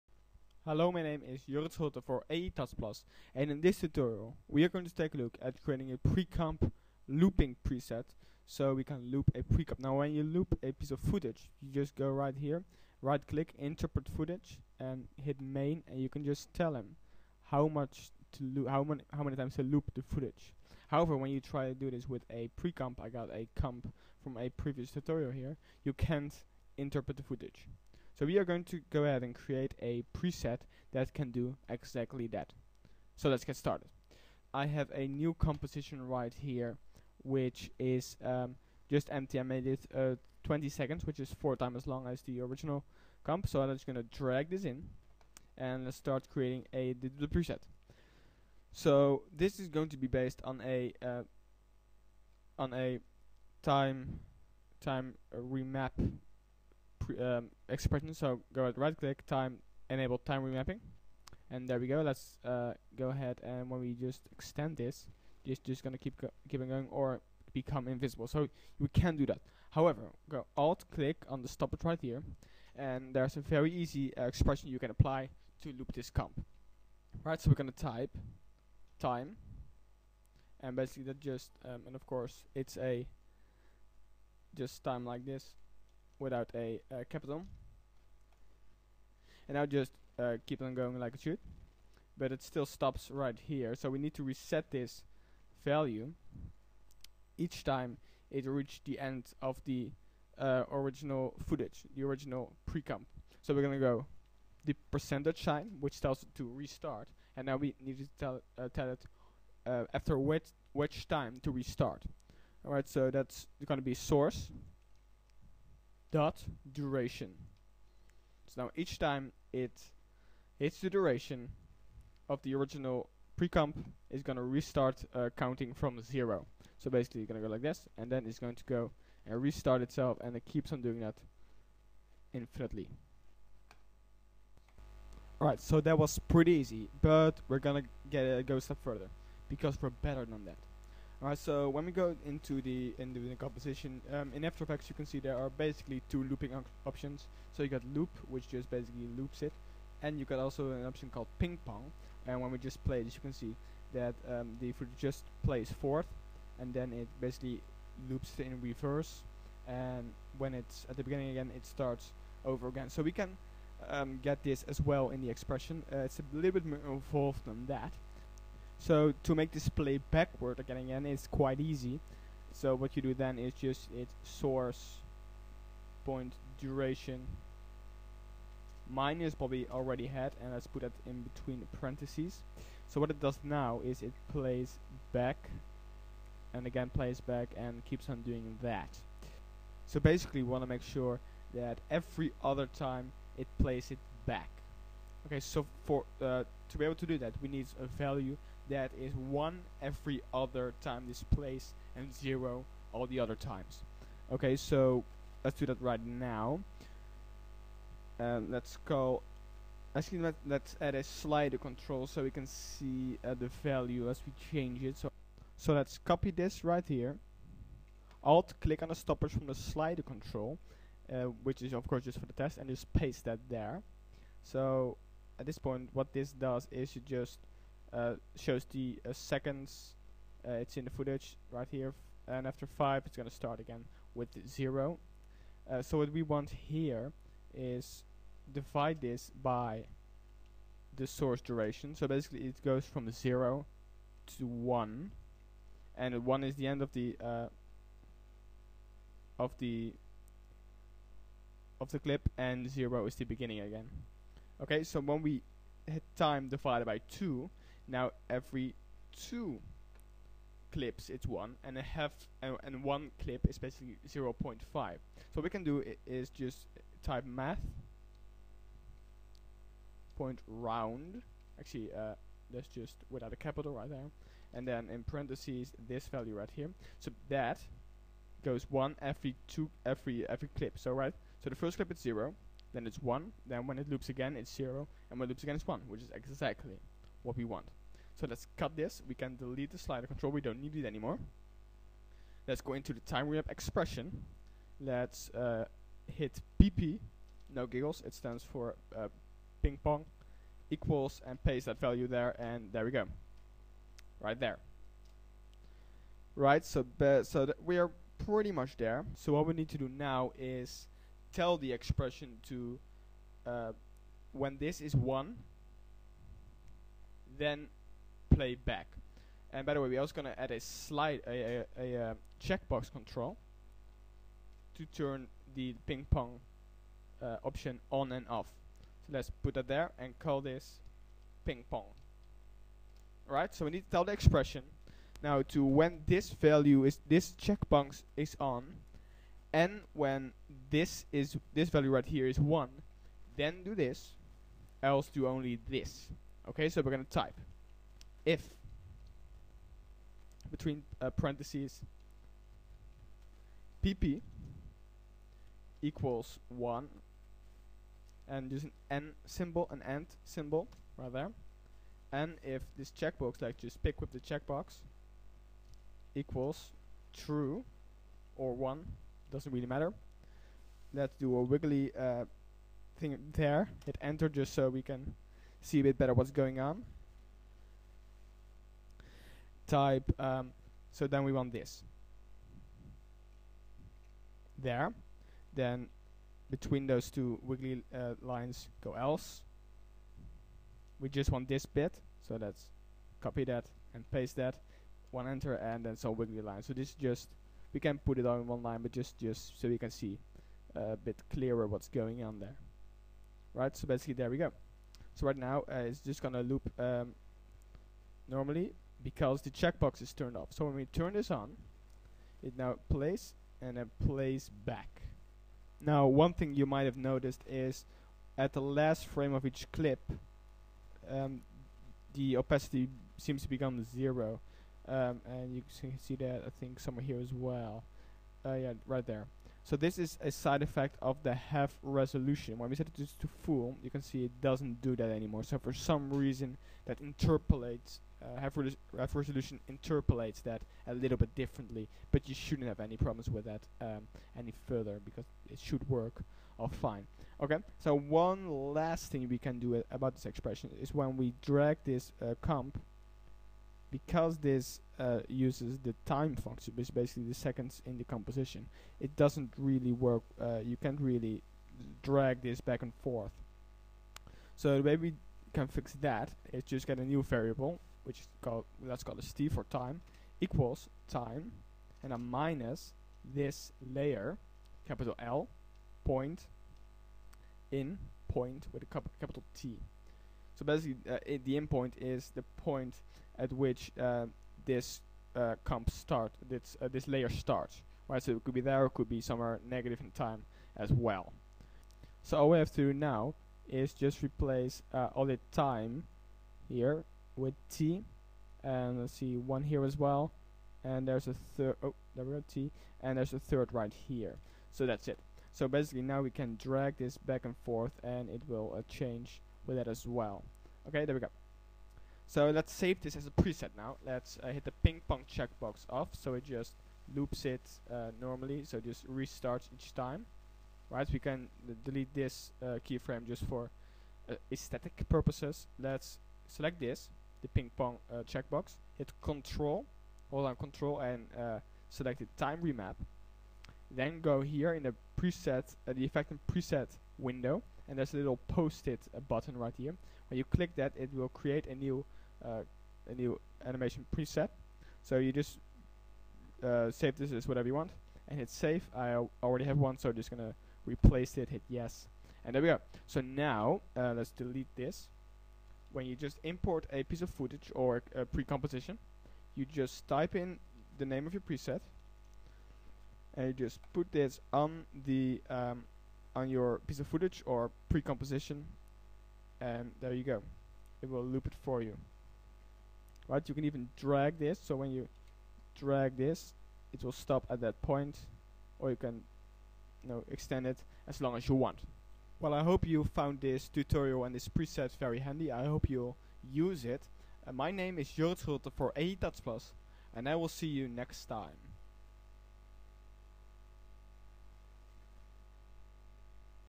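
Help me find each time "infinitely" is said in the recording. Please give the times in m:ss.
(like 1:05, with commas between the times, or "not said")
2:12.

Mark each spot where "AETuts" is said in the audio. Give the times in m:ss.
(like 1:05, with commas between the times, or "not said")
0:02.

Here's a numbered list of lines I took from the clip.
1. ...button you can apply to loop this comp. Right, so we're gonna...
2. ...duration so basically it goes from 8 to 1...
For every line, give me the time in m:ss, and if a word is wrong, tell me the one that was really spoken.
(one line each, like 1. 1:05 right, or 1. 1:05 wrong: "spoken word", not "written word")
1. 1:14 wrong: "expression", not "button"
2. 4:01 wrong: "0", not "8".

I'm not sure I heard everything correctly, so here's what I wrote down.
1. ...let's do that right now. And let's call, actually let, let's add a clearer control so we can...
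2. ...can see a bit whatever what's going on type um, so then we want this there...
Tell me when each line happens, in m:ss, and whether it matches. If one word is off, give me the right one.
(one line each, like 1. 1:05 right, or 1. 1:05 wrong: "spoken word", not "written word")
1. 3:25 wrong: "slider", not "clearer"
2. 6:14 wrong: "better", not "whatever".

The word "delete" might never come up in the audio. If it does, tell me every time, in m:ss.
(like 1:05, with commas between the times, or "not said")
4:49, 8:41, 9:14.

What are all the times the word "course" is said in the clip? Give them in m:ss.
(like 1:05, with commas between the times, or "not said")
1:22, 3:41.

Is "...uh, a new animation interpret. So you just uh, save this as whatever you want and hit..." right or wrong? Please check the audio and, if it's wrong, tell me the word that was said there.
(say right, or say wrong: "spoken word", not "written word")
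wrong: "preset", not "interpret".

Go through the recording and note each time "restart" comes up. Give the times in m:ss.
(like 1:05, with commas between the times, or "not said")
1:46, 1:51, 2:04, 2:09, 8:39.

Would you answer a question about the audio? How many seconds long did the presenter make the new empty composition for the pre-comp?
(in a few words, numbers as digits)
20.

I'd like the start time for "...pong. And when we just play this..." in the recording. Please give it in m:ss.
2:31.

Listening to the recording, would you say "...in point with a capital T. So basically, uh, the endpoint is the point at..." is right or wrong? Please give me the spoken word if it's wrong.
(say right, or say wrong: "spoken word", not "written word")
right.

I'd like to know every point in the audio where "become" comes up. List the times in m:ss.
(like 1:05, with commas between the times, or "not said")
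1:07, 7:03.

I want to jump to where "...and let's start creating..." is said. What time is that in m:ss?
0:45.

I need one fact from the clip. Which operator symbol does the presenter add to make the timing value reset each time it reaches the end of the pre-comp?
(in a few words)
percentage sign.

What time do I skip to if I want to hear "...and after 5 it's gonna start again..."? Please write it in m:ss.
3:52.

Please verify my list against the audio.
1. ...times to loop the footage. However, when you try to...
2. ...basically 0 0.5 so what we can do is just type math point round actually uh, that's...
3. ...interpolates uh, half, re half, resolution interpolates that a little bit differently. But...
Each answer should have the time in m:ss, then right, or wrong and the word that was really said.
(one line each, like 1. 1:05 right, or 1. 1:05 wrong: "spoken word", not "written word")
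1. 0:19 right
2. 4:23 right
3. 7:16 right.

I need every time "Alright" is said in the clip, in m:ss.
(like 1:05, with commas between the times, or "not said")
1:52, 2:15, 2:21.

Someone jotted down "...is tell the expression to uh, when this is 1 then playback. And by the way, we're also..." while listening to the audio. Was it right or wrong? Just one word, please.
right.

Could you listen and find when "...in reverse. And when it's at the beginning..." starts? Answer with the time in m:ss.
2:38.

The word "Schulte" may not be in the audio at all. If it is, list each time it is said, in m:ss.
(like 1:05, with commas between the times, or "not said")
0:01, 9:48.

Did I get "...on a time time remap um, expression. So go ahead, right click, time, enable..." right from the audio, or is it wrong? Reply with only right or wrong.
right.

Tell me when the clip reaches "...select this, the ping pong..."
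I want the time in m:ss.
8:46.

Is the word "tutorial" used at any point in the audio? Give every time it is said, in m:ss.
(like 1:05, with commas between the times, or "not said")
0:03, 0:24, 9:43.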